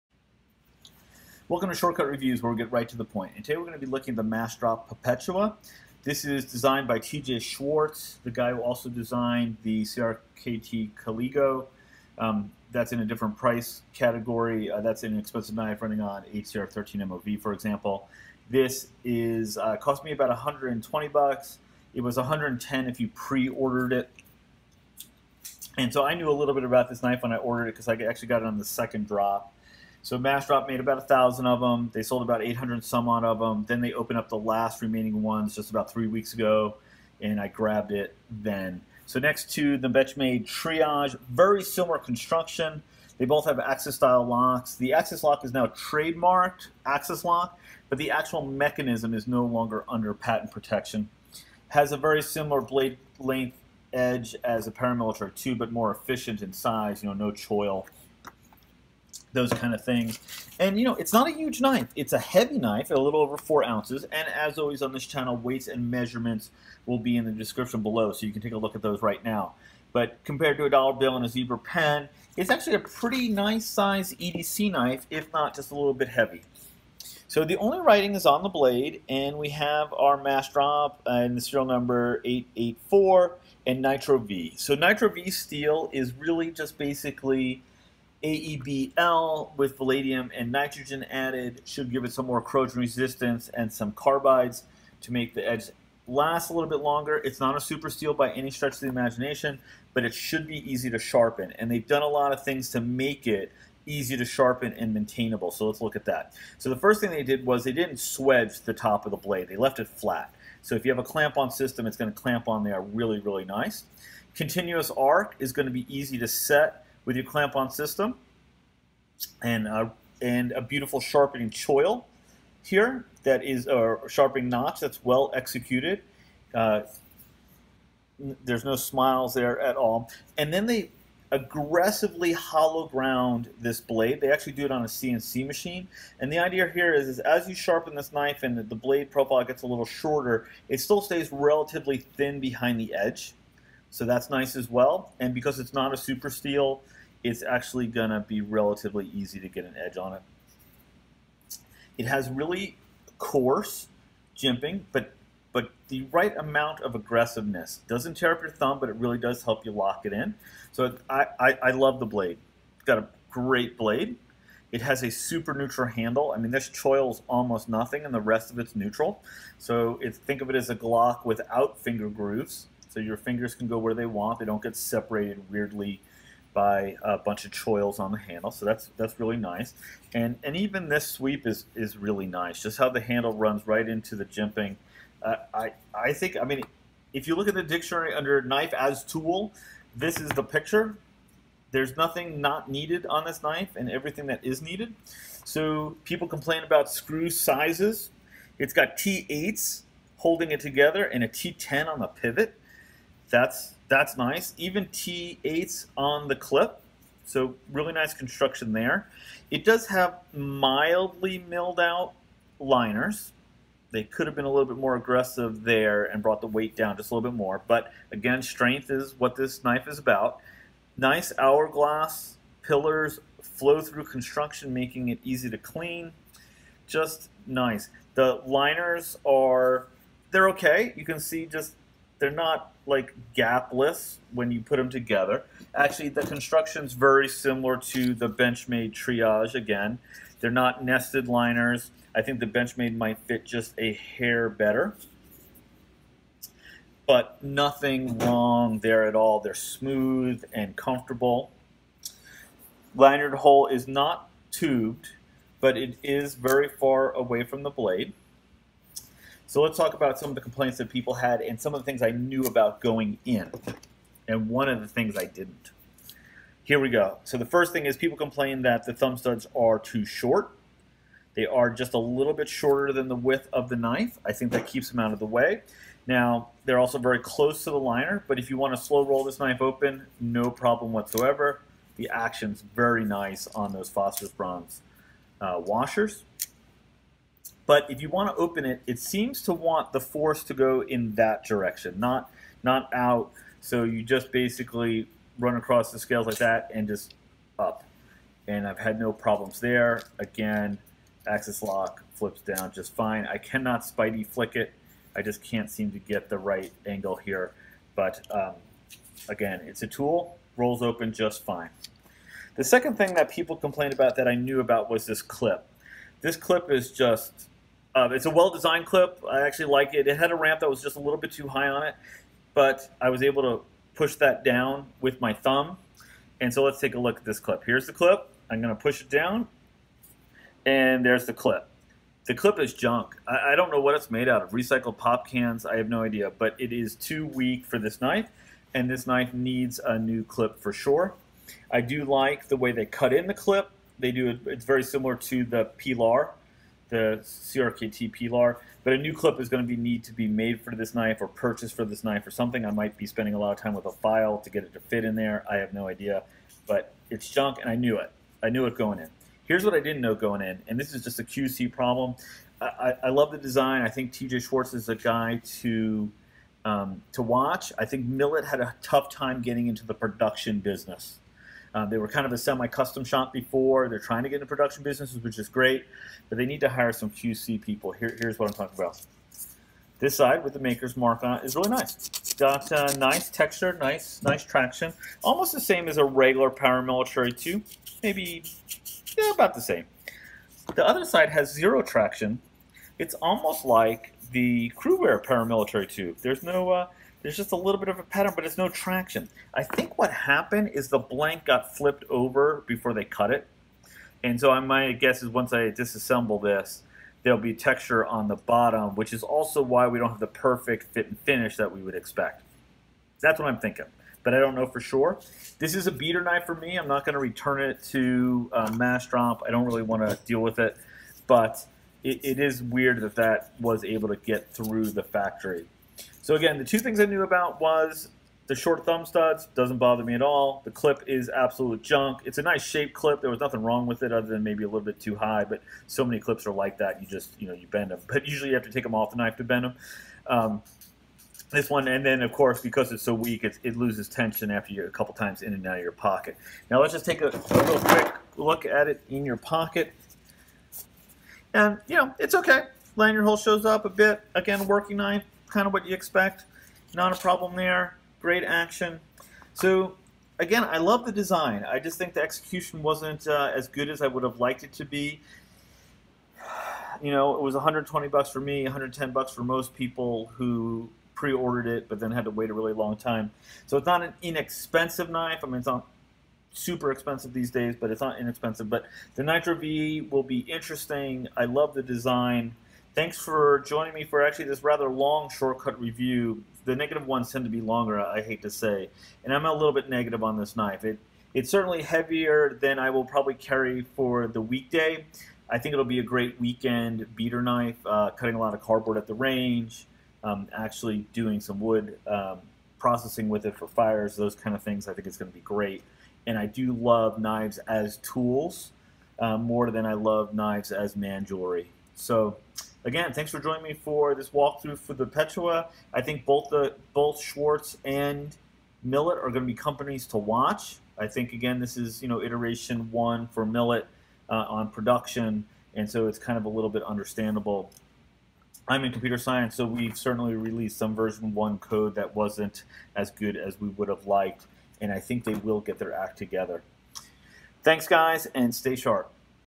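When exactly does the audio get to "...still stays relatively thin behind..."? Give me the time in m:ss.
2:20.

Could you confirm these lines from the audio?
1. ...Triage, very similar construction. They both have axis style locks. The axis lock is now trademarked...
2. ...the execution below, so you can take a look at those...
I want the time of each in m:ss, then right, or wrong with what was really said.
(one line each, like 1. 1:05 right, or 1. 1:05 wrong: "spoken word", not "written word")
1. 0:40 right
2. 1:07 wrong: "description", not "execution".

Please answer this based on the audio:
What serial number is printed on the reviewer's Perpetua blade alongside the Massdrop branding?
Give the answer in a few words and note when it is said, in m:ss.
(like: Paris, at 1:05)
884, at 1:22.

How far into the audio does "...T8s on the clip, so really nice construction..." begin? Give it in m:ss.
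3:24.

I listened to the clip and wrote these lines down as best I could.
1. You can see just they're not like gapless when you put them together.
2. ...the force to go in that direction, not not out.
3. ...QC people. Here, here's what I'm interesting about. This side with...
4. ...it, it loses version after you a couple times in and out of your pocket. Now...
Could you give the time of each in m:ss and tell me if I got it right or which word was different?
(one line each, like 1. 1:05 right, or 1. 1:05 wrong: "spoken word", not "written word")
1. 3:50 right
2. 4:49 right
3. 6:17 wrong: "talking", not "interesting"
4. 7:23 wrong: "tension", not "version".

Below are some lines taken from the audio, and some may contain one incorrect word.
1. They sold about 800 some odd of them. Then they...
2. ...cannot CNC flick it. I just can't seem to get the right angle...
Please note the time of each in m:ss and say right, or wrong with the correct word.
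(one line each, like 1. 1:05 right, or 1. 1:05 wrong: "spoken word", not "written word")
1. 0:31 right
2. 5:03 wrong: "Spidey", not "CNC".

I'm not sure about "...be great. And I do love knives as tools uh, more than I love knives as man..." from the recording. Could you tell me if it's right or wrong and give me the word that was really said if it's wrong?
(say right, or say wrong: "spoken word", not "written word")
right.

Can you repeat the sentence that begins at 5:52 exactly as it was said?
I might be spending a lot of time with a file to get it to fit in there.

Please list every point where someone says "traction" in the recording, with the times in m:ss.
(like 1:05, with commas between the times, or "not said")
6:24, 6:31, 6:38.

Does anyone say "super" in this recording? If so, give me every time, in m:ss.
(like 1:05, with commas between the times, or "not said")
1:37, 2:25, 2:45, 7:56.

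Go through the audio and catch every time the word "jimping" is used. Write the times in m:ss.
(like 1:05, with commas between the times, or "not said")
2:34, 3:04.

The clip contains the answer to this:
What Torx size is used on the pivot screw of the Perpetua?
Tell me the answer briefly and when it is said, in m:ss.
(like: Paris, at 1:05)
T10, at 3:21.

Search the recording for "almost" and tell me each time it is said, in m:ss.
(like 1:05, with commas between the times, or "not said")
2:47, 6:25, 6:33.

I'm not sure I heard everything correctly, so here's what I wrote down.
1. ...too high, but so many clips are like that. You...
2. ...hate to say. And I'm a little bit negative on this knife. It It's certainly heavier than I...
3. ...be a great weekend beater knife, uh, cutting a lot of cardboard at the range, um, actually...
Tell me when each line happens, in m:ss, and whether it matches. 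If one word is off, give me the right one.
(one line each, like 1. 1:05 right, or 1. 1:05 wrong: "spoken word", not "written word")
1. 7:14 right
2. 8:08 right
3. 8:15 right.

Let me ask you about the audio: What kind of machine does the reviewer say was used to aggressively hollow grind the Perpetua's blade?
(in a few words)
CNC machine.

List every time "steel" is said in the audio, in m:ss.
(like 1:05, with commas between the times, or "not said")
1:25, 1:37, 2:26.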